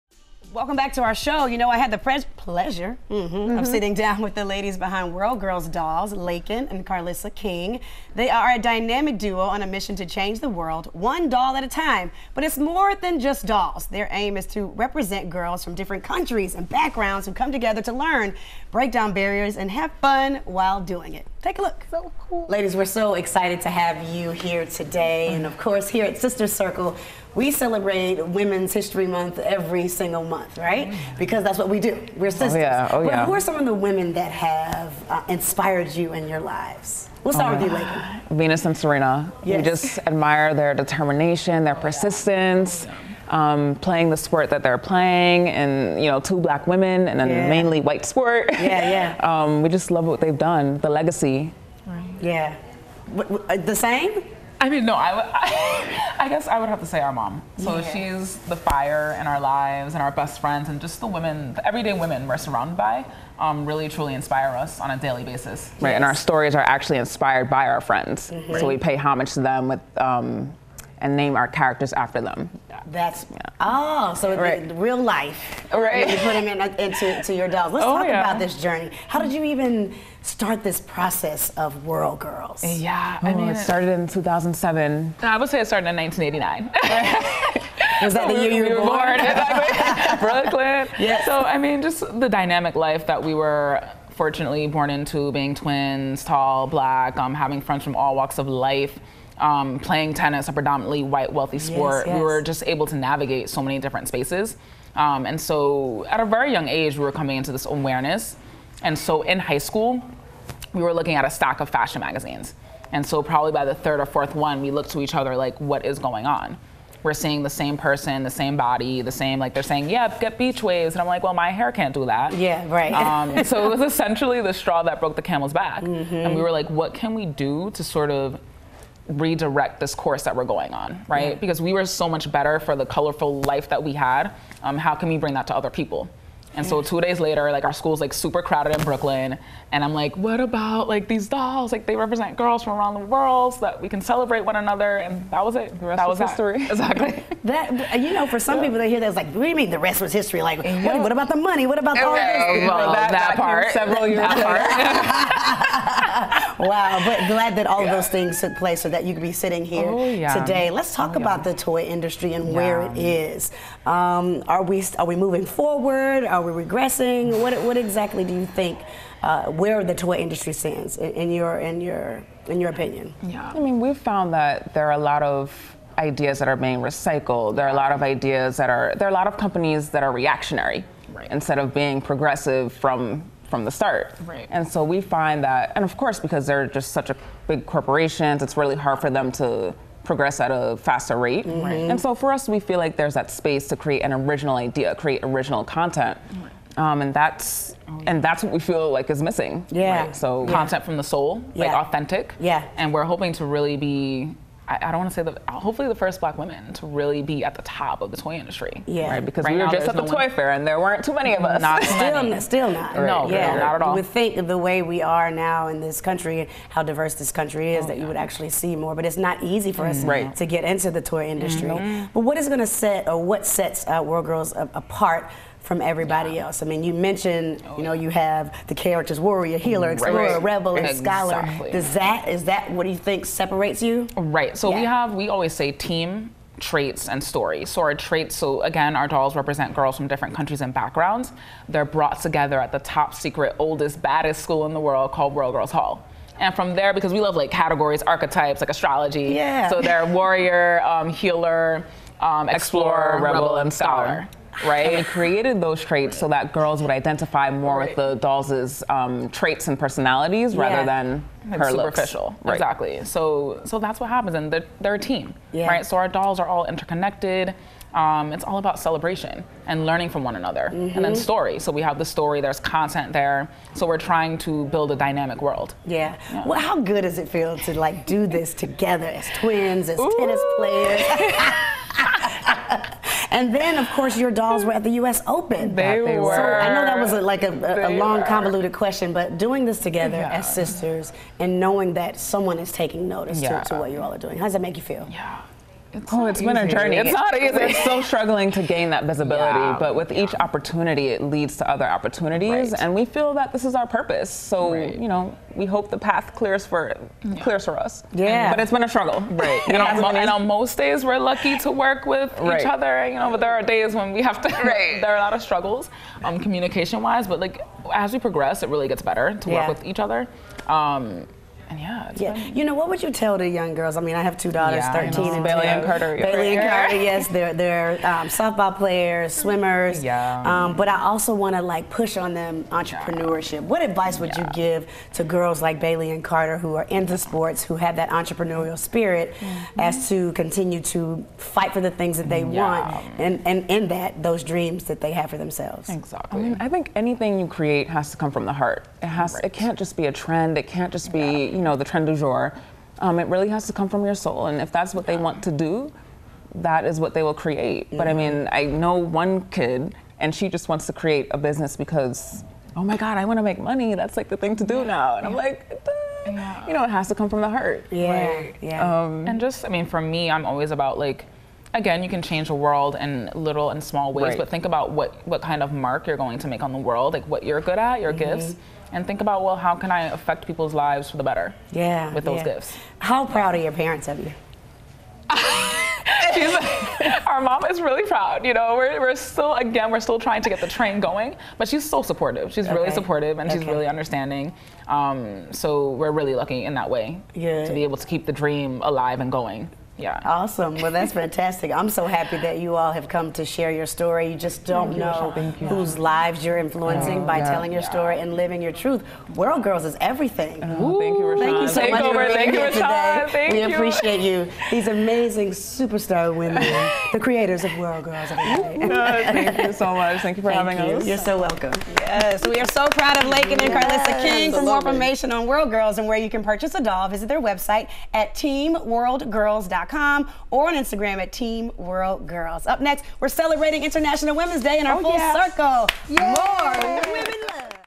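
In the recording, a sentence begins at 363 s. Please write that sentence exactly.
That's like the thing to do yeah.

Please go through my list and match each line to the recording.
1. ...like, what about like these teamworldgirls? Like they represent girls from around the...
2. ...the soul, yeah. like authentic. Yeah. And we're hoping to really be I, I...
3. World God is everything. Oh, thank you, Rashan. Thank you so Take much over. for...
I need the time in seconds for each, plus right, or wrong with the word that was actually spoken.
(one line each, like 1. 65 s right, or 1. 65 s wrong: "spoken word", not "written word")
1. 139 s wrong: "dolls", not "teamworldgirls"
2. 200 s right
3. 409 s wrong: "Girls", not "God".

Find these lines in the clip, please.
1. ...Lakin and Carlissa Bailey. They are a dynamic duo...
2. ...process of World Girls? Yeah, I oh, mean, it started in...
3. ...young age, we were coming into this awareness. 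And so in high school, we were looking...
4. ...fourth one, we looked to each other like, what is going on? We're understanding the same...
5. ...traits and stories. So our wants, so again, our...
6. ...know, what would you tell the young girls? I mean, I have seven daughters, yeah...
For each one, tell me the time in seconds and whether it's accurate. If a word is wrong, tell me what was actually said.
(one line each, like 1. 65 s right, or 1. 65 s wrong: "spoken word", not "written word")
1. 6 s wrong: "King", not "Bailey"
2. 80 s right
3. 106 s right
4. 114 s wrong: "seeing", not "understanding"
5. 236 s wrong: "traits", not "wants"
6. 322 s wrong: "two", not "seven".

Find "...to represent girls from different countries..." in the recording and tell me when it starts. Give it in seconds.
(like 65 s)
14 s.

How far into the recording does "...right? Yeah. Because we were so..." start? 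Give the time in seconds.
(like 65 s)
131 s.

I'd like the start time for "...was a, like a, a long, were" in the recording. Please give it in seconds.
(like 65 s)
286 s.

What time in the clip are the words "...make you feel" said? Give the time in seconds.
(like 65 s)
294 s.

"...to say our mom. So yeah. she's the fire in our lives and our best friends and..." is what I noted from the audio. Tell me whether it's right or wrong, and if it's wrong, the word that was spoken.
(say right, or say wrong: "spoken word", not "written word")
right.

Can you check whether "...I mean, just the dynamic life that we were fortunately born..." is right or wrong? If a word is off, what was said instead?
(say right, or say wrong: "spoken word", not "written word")
right.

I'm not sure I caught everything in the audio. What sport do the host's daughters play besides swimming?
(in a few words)
Softball.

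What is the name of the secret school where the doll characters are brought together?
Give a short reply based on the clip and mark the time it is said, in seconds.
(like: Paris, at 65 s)
World Girls Hall, at 245 s.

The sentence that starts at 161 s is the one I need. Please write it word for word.
about the toy industry and where it is.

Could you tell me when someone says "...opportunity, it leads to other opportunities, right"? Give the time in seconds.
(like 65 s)
300 s.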